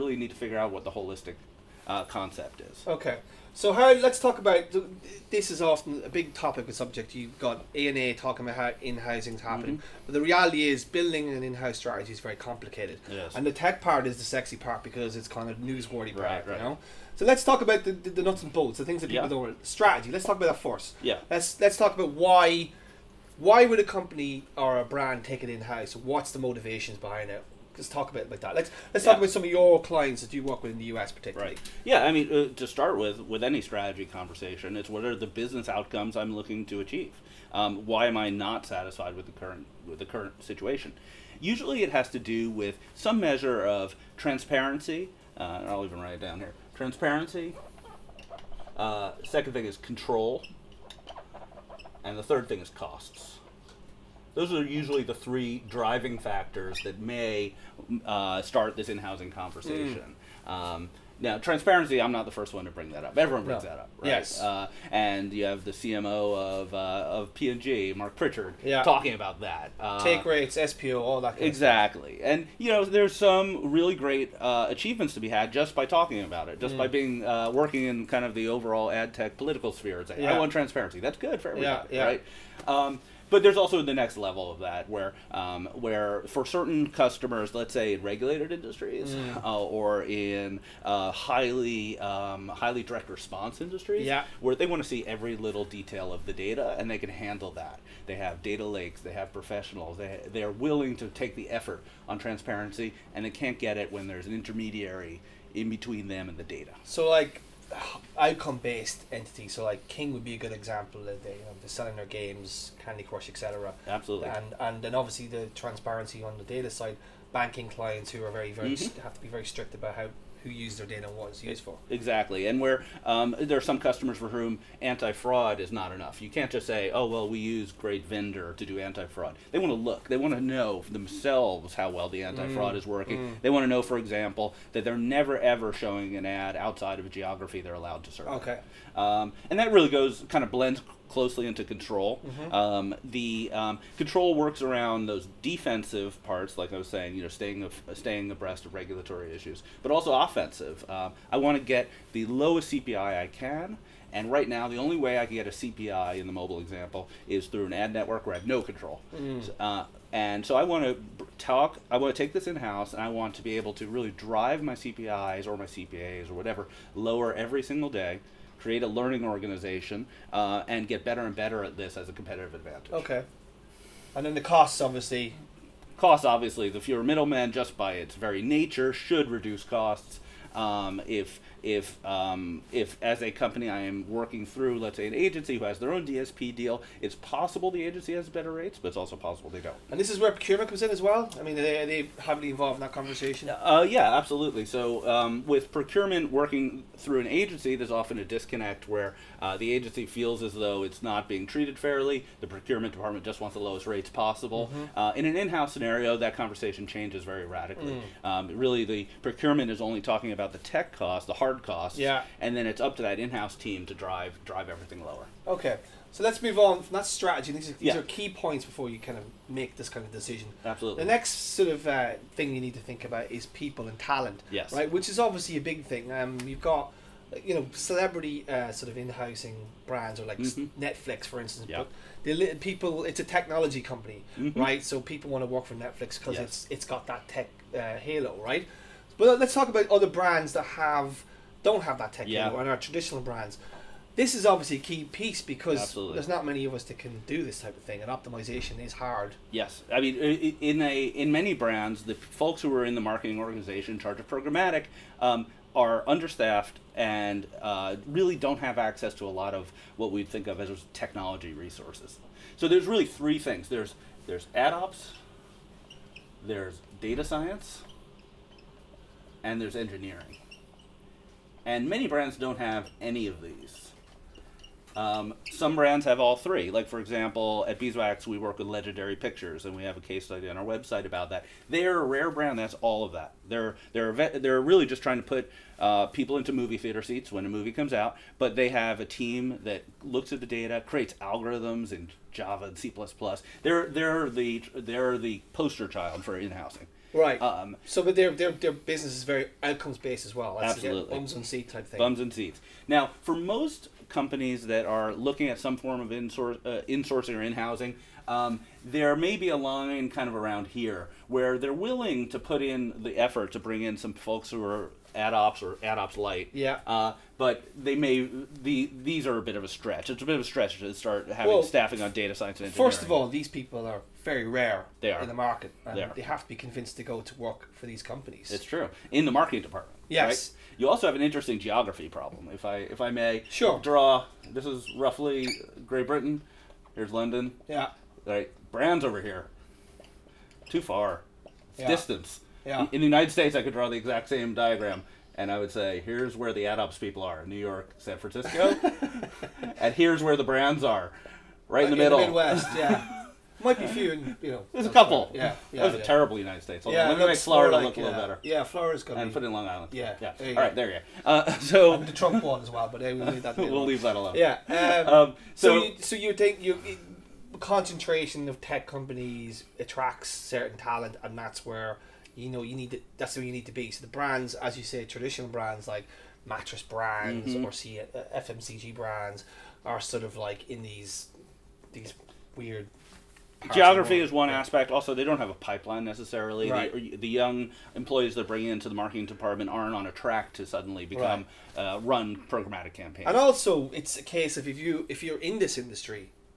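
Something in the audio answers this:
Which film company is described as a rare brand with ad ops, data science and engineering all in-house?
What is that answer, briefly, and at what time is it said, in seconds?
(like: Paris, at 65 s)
Legendary Pictures, at 278 s.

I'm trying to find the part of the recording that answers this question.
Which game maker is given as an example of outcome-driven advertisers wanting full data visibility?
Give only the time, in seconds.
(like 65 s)
109 s.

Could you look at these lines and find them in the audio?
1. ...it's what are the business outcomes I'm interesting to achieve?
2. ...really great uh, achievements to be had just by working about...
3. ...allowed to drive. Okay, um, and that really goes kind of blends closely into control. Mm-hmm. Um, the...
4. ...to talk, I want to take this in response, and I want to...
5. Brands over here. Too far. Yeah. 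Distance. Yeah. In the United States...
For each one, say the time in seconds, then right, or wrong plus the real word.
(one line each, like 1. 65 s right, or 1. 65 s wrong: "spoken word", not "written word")
1. 34 s wrong: "looking", not "interesting"
2. 73 s wrong: "talking", not "working"
3. 137 s wrong: "serve", not "drive"
4. 160 s wrong: "house", not "response"
5. 338 s right.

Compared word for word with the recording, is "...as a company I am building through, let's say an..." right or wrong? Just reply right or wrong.
wrong.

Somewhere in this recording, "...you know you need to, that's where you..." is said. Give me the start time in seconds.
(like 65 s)
372 s.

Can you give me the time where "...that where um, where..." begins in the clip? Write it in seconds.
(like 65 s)
84 s.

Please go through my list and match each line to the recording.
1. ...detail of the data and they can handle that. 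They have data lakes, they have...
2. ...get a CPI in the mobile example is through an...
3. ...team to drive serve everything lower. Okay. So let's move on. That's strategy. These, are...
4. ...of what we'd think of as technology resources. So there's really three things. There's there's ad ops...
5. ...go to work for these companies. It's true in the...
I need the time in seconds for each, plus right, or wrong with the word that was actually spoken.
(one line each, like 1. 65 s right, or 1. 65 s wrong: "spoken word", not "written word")
1. 95 s right
2. 155 s right
3. 213 s wrong: "drive", not "serve"
4. 259 s right
5. 327 s right.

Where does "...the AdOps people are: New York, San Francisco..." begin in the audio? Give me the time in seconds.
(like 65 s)
346 s.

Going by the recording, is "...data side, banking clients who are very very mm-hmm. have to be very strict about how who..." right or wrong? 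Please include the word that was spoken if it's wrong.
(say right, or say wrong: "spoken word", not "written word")
right.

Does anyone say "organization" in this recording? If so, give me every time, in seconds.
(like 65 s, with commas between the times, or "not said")
169 s, 253 s.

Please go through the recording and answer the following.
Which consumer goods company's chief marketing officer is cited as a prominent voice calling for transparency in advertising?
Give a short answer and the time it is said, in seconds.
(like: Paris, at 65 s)
P&G, at 67 s.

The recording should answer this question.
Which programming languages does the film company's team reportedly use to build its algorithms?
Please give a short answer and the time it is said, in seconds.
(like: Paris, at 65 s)
Java and C++, at 292 s.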